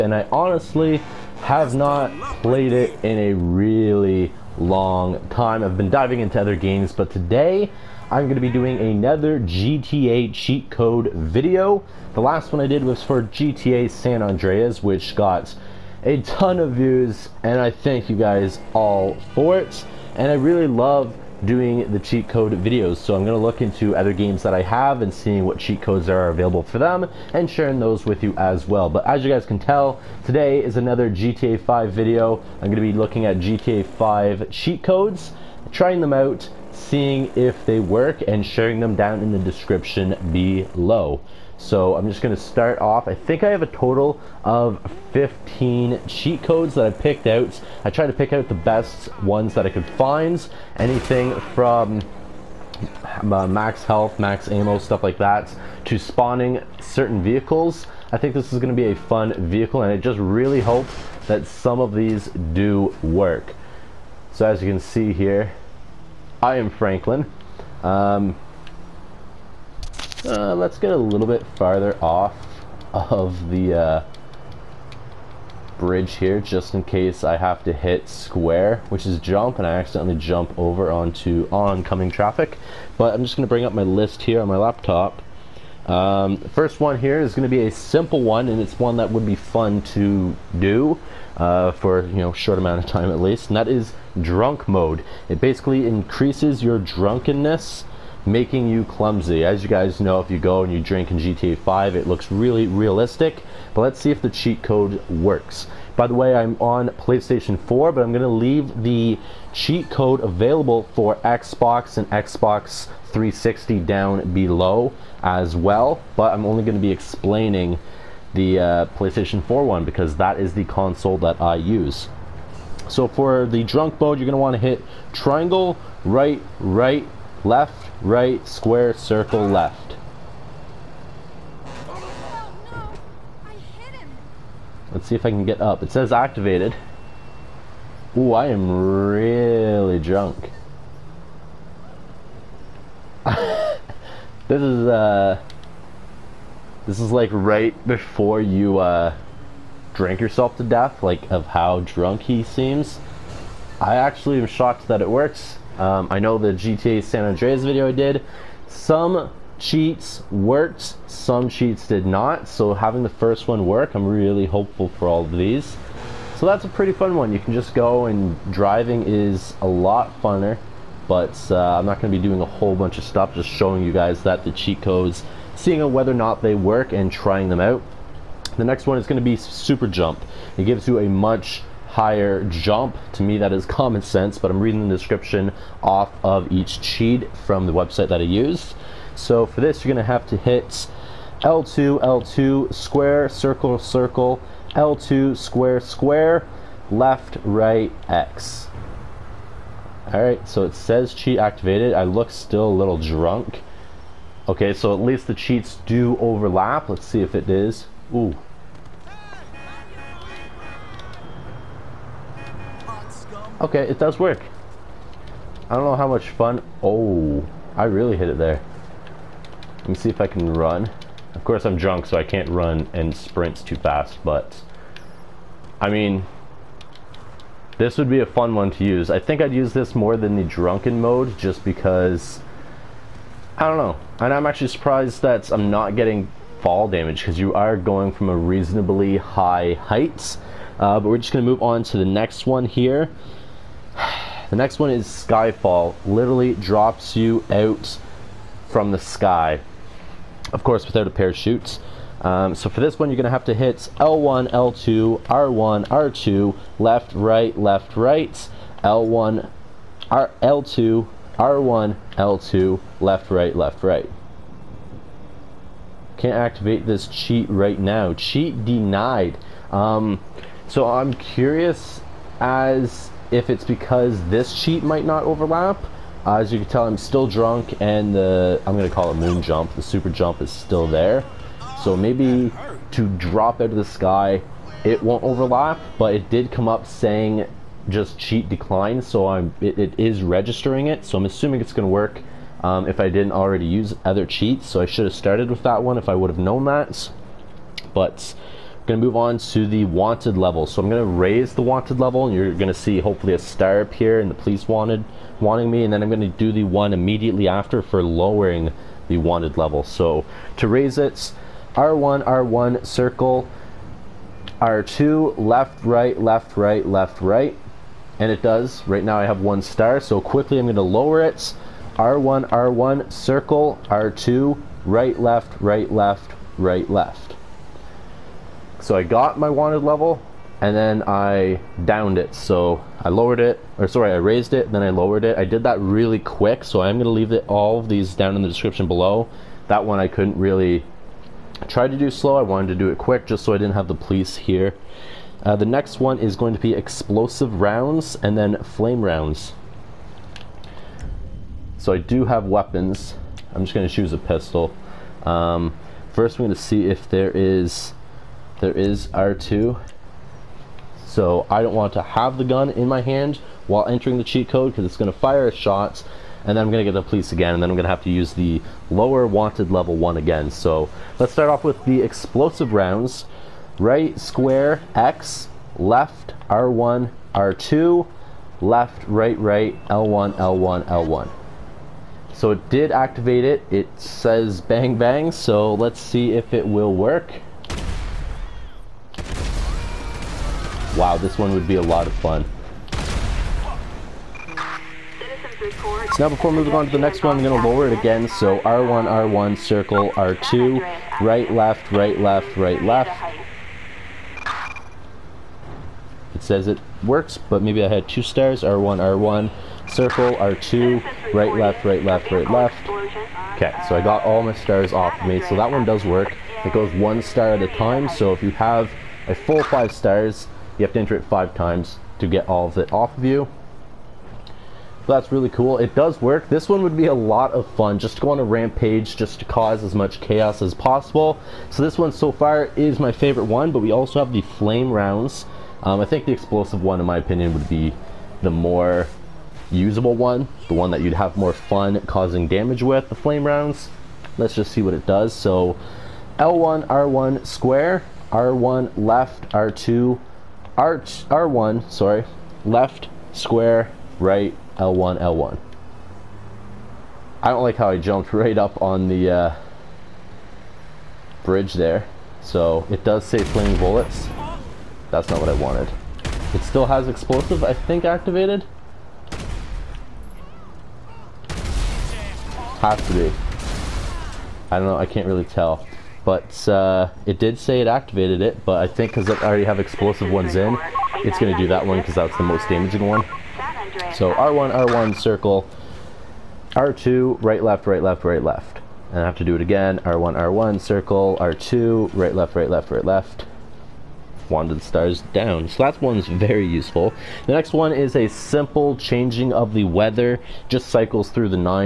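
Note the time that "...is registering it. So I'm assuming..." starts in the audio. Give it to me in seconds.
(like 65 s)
289 s.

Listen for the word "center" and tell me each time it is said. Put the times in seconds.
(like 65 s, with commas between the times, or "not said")
not said.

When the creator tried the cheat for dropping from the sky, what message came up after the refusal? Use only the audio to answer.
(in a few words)
Cheat denied.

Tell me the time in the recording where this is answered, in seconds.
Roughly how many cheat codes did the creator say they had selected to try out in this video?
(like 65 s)
45 s.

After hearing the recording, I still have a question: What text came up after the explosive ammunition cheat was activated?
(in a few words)
bang bang.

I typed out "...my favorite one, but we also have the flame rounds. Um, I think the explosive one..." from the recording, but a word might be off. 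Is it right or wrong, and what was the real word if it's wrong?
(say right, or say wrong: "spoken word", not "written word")
right.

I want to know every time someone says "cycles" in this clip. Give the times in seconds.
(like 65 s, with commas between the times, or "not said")
500 s.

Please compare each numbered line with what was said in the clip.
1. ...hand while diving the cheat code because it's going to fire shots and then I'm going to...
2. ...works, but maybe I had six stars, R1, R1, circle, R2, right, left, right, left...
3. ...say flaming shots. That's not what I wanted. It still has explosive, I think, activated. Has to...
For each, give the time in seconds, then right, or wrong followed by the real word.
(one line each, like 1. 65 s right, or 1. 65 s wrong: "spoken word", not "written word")
1. 363 s wrong: "entering", not "diving"
2. 407 s wrong: "two", not "six"
3. 463 s wrong: "bullets", not "shots".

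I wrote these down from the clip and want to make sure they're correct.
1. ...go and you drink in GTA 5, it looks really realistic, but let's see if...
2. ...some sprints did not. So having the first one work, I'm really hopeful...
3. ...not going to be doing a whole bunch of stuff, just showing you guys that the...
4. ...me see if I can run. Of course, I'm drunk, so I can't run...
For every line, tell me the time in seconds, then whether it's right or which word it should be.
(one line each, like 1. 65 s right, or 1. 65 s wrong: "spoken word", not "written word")
1. 100 s right
2. 161 s wrong: "cheats", not "sprints"
3. 171 s right
4. 219 s right.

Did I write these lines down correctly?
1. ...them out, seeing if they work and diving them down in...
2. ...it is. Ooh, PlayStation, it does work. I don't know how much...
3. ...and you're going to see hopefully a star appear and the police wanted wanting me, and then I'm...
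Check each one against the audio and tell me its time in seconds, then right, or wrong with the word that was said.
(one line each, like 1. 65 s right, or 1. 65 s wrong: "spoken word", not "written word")
1. 36 s wrong: "sharing", not "diving"
2. 207 s wrong: "Okay", not "PlayStation"
3. 302 s right.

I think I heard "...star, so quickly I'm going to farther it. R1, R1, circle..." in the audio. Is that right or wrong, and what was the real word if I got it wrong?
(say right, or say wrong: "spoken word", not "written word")
wrong: "lower", not "farther".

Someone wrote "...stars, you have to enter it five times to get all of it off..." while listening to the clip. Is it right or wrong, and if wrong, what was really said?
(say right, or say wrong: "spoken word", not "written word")
right.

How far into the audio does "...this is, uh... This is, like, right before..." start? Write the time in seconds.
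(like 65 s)
143 s.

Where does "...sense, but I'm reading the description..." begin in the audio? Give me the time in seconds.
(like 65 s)
184 s.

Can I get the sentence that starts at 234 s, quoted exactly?
And I'm actually surprised that I'm not getting fall damage, because you are going from a reasonably high height.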